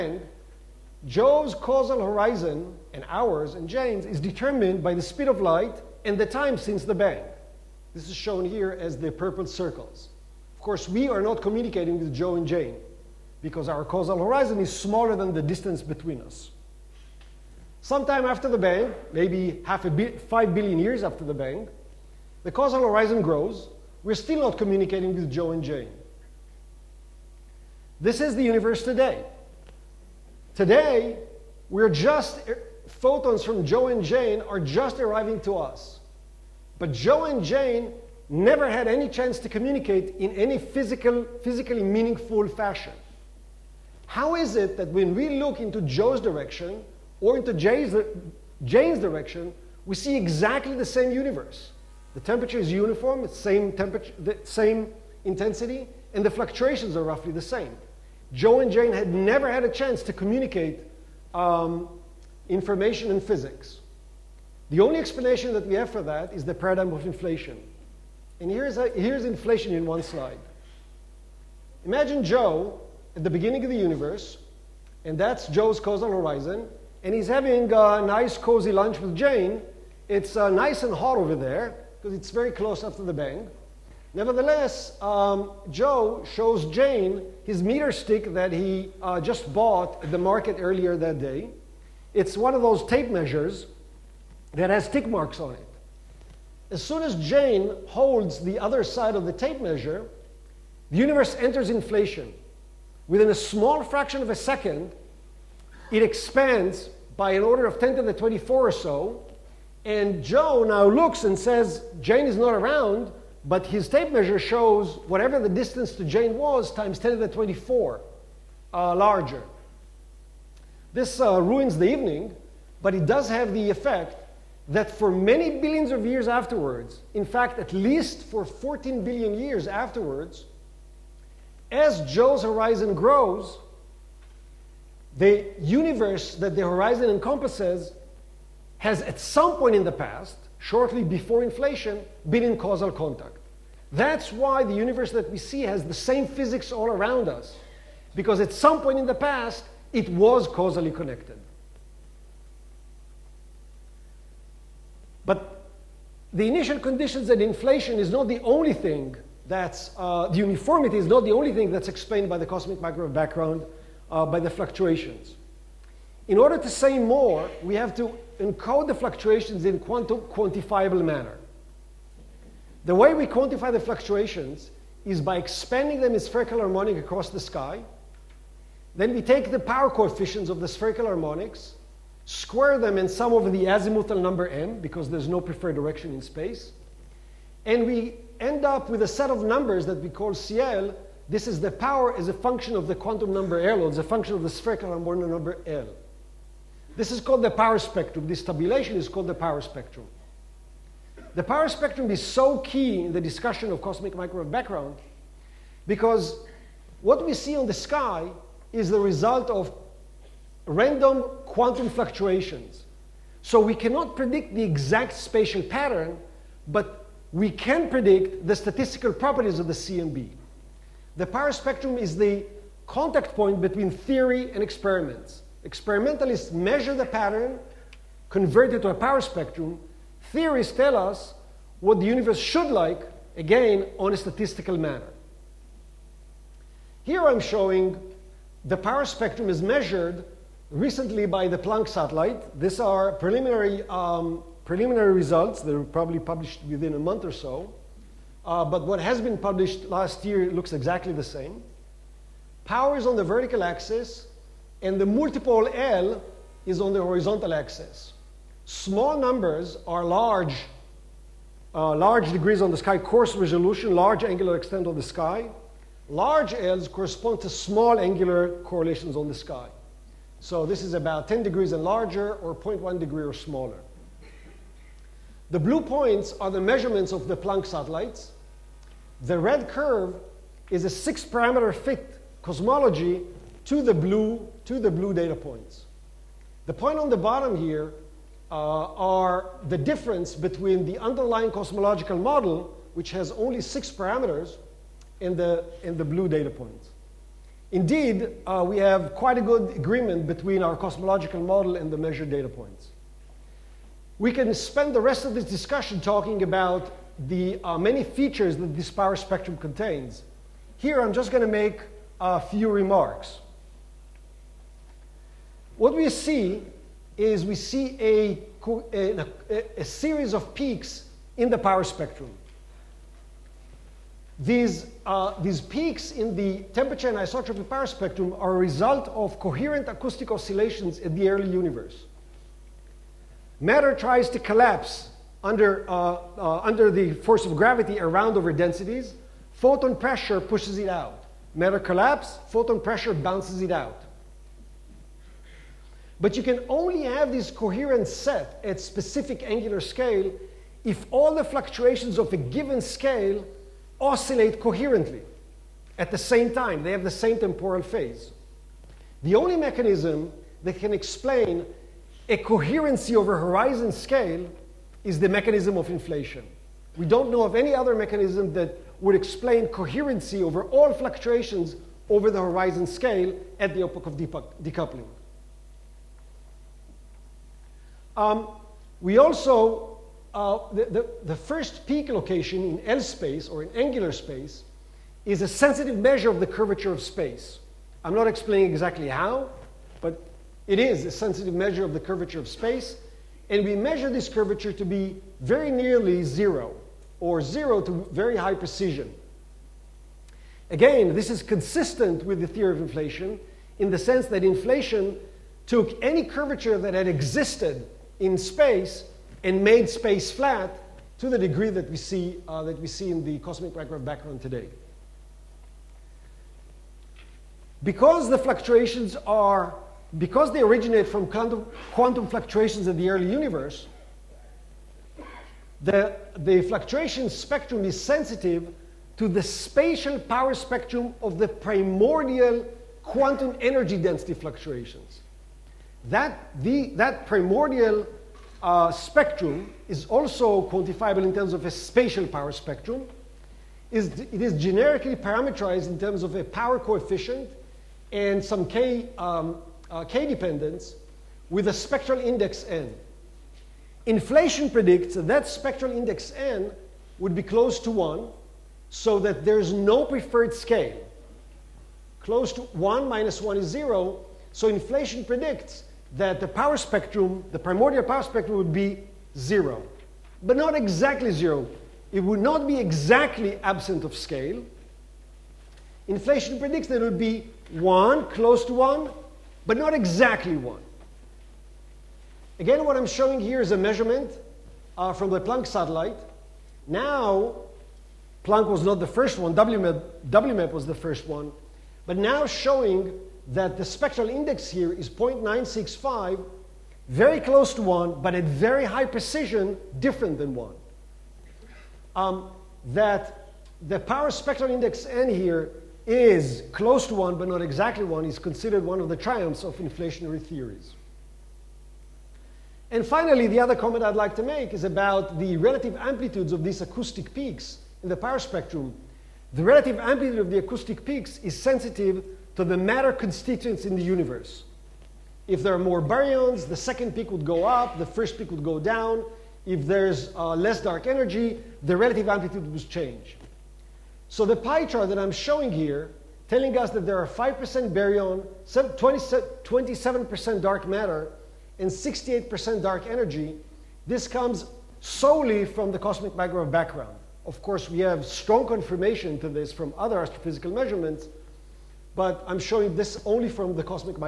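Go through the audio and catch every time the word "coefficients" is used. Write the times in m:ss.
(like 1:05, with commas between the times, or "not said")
2:59, 7:26.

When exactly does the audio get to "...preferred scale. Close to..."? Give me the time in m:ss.
7:40.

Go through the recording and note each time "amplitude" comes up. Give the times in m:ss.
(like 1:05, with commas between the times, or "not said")
8:35, 8:39, 8:52.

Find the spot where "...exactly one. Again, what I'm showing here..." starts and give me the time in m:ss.
7:59.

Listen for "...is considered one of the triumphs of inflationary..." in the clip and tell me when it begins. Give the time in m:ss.
8:28.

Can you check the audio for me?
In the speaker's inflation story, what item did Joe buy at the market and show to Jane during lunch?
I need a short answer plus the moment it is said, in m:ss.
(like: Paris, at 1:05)
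meter stick, at 1:27.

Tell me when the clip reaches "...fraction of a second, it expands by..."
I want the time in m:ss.
1:43.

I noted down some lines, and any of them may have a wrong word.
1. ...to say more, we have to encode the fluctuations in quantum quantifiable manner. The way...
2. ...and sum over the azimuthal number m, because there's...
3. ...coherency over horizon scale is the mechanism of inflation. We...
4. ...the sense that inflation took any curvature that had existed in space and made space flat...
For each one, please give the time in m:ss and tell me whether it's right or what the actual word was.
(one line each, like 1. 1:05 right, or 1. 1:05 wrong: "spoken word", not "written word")
1. 2:46 right
2. 3:02 right
3. 6:02 right
4. 6:43 right.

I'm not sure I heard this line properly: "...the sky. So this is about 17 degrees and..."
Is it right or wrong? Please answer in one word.
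wrong.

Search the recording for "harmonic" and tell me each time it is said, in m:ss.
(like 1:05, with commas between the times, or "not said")
2:56, 3:01, 3:14.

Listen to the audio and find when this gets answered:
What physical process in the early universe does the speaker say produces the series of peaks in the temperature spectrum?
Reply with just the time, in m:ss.
5:29.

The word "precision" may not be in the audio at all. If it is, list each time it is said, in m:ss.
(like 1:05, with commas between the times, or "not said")
6:38, 8:19.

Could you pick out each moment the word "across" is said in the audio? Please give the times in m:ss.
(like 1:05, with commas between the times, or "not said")
2:56.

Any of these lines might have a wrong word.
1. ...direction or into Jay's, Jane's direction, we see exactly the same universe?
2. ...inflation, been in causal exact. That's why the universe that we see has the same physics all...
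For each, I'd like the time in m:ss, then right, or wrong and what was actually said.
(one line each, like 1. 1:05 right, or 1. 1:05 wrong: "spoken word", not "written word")
1. 0:46 right
2. 2:21 wrong: "contact", not "exact".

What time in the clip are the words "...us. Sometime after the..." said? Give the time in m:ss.
0:16.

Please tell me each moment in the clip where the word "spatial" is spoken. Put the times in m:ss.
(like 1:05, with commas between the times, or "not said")
3:35, 7:09, 7:21.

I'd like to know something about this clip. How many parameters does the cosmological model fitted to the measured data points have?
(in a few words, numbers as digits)
6.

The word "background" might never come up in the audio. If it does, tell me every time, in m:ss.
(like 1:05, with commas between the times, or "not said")
2:43, 3:24, 6:54, 9:06.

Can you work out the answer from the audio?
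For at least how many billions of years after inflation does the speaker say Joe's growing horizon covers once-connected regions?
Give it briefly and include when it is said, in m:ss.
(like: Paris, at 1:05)
14 billion years, at 2:08.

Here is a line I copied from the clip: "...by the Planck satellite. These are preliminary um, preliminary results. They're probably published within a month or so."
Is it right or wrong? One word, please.
right.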